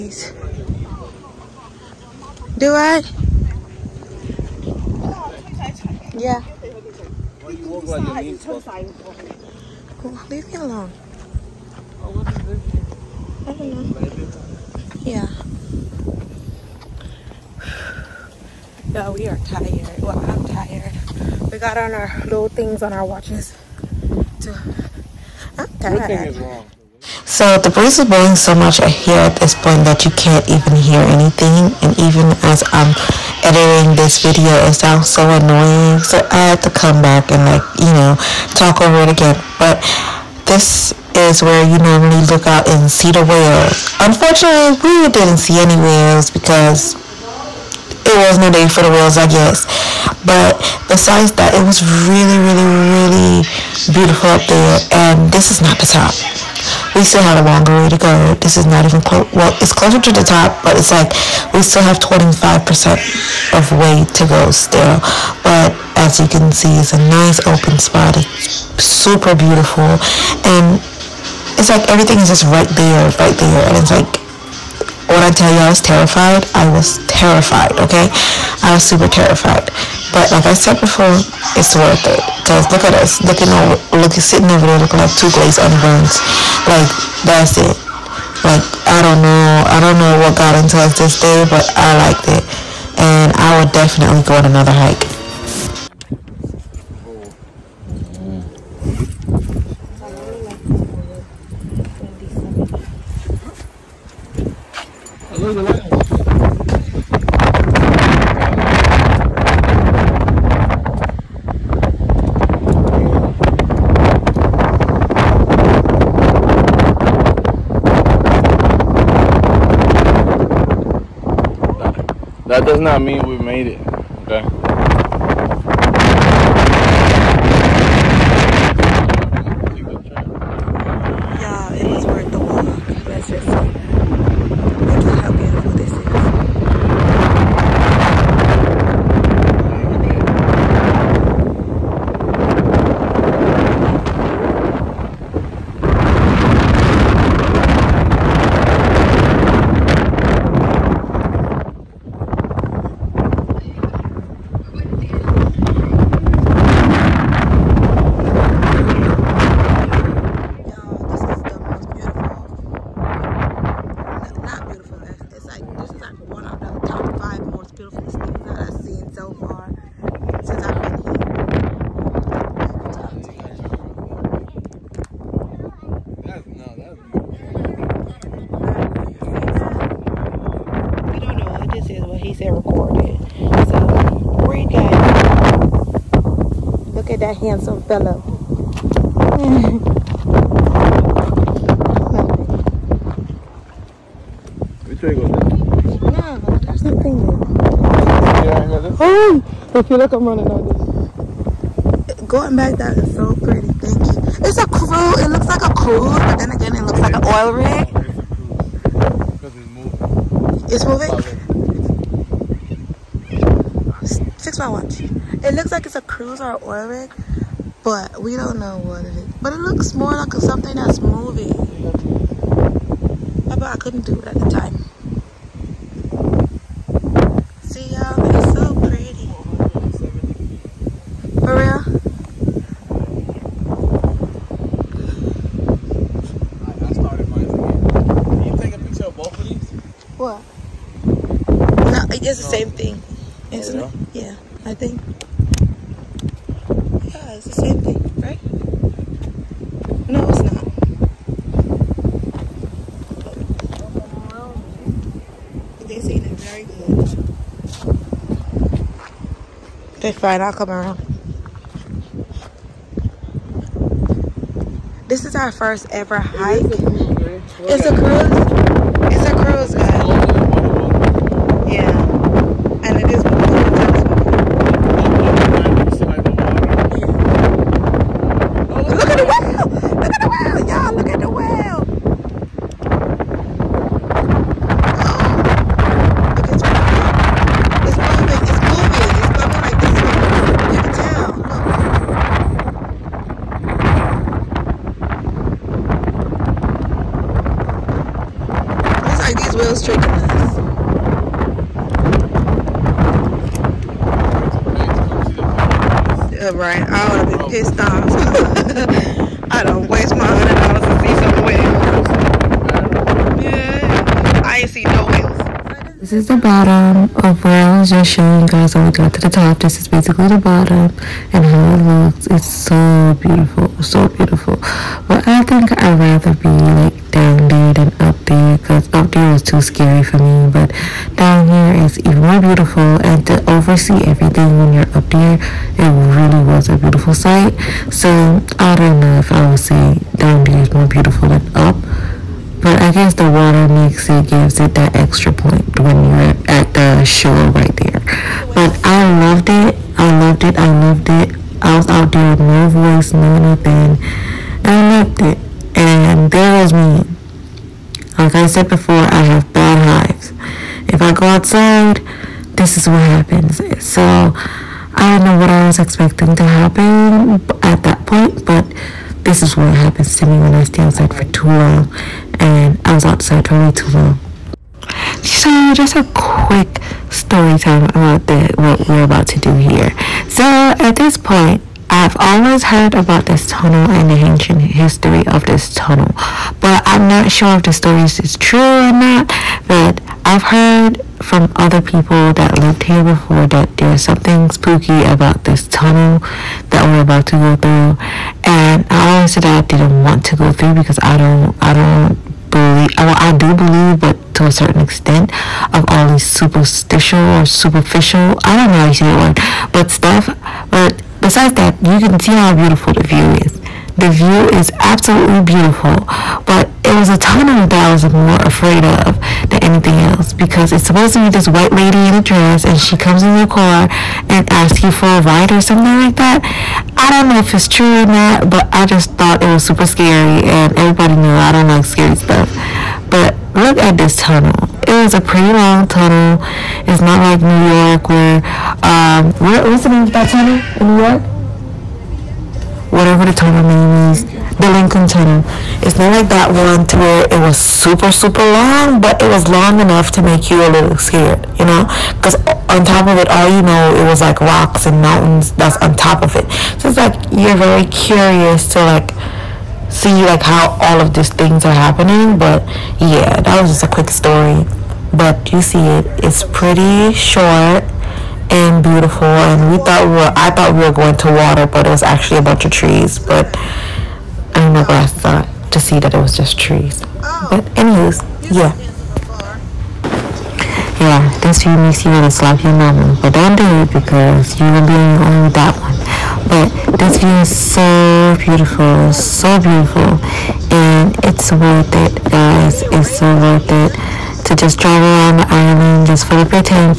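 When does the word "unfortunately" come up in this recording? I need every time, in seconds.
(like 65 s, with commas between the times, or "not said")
44 s.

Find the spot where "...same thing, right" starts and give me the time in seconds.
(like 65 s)
247 s.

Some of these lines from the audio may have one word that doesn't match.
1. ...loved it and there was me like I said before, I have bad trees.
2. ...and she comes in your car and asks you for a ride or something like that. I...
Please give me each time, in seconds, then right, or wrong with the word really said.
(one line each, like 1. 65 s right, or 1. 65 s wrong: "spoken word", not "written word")
1. 355 s wrong: "hives", not "trees"
2. 422 s right.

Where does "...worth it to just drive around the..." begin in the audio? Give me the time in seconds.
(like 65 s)
493 s.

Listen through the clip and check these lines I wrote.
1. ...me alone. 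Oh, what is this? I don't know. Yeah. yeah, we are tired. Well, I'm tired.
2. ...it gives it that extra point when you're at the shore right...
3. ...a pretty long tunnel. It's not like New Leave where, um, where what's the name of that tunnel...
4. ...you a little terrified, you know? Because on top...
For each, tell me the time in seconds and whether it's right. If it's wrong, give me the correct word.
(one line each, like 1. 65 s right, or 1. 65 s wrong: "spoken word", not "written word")
1. 10 s right
2. 344 s right
3. 435 s wrong: "York", not "Leave"
4. 450 s wrong: "scared", not "terrified".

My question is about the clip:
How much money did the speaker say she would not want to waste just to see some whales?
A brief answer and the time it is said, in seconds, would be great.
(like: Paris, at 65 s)
$100, at 310 s.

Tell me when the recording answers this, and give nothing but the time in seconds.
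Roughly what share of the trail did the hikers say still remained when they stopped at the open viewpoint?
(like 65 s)
62 s.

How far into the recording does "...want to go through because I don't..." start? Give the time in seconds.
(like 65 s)
400 s.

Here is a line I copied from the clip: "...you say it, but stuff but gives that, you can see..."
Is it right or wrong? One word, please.
wrong.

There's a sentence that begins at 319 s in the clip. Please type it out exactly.
This is basically the bottom and how it looks.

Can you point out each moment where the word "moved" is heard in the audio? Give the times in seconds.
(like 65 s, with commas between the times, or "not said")
not said.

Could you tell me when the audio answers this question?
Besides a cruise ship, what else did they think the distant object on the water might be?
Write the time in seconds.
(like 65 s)
207 s.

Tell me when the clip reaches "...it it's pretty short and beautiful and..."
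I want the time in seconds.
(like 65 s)
465 s.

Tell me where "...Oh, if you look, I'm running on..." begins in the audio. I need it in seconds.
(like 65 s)
199 s.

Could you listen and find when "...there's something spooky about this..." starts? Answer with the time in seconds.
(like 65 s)
393 s.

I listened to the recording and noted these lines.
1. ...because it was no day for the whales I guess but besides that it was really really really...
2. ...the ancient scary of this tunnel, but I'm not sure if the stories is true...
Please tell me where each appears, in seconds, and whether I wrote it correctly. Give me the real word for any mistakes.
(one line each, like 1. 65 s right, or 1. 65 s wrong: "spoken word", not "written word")
1. 46 s right
2. 384 s wrong: "history", not "scary".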